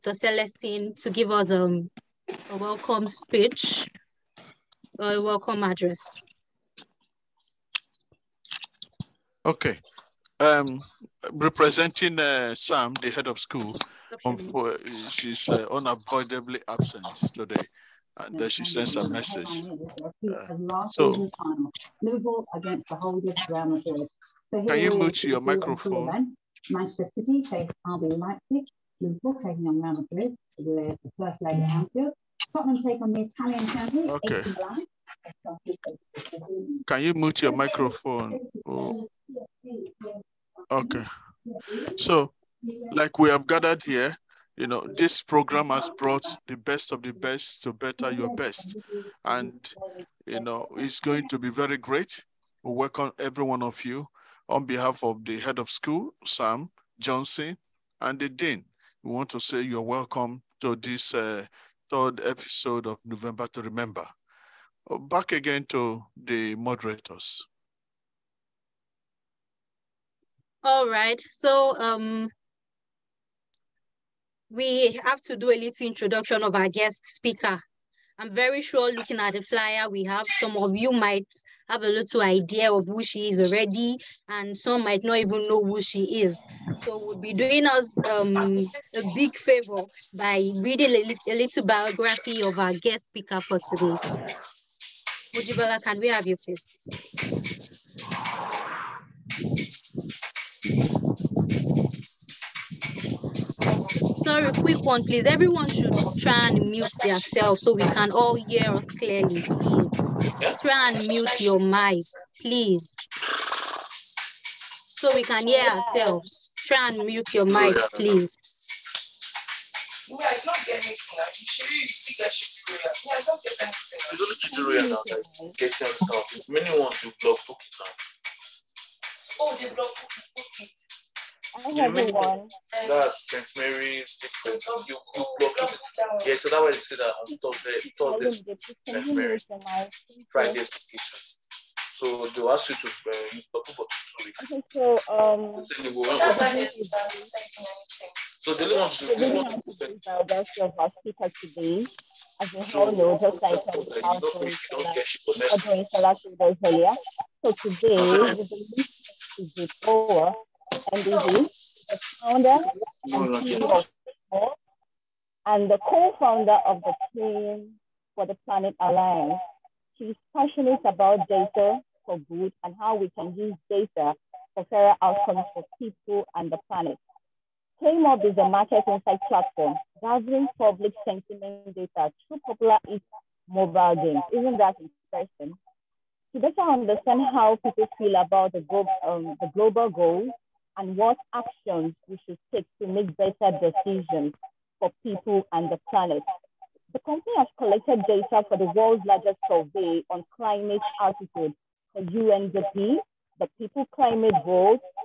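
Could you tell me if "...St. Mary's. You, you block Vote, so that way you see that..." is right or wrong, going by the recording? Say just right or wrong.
wrong.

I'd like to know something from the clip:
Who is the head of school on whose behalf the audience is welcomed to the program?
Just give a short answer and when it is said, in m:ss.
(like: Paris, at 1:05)
Sam Johnson, at 0:56.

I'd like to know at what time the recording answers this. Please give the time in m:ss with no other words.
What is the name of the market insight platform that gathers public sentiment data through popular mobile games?
2:57.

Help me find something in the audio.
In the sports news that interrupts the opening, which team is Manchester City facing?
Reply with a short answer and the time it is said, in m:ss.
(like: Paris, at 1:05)
RB Leipzig, at 0:27.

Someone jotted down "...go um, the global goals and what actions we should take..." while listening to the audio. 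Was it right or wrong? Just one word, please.
right.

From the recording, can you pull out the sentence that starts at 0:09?
Okay um, representing uh, Sam, the head of school, um, for, uh, she's uh, unavoidably absent today.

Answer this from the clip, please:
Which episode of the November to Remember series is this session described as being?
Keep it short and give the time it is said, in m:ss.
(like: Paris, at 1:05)
third, at 1:01.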